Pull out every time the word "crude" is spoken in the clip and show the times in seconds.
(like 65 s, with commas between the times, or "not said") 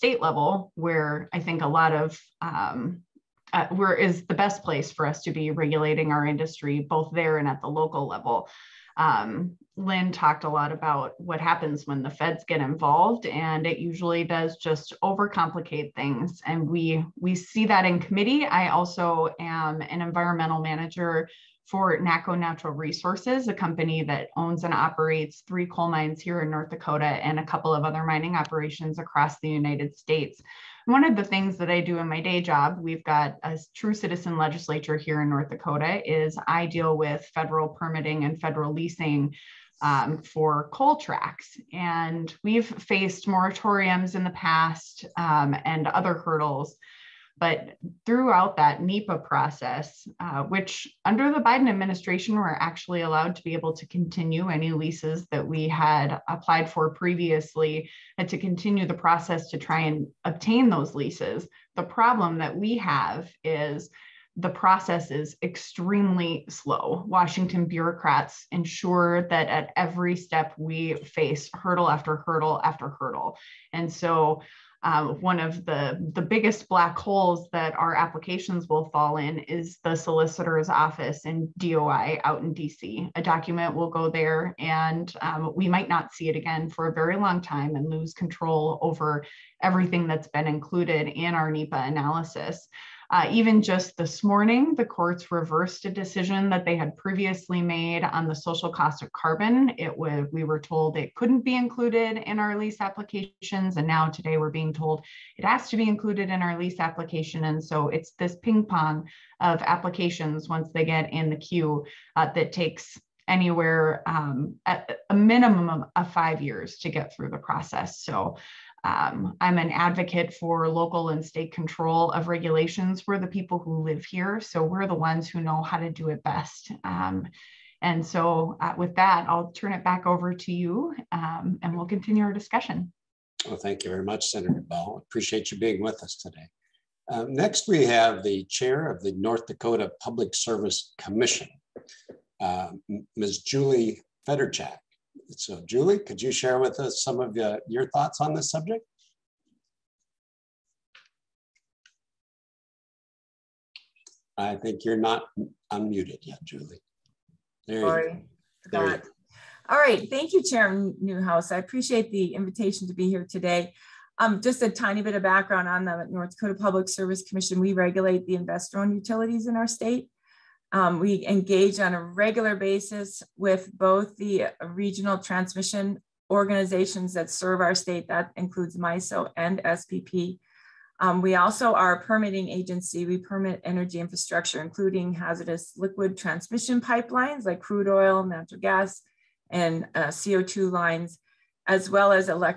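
187 s.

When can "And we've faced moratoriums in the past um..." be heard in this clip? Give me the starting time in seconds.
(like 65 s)
41 s.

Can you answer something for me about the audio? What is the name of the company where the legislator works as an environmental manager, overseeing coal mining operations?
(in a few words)
NACCO Natural Resources.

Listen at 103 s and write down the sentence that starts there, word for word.
And now today we're being told it has to be included in our lease application.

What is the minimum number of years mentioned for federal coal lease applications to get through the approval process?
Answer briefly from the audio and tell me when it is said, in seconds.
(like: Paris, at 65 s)
5, at 116 s.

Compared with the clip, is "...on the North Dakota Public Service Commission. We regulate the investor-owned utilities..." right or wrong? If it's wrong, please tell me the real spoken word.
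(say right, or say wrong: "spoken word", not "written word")
right.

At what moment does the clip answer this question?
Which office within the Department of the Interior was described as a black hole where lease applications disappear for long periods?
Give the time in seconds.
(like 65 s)
79 s.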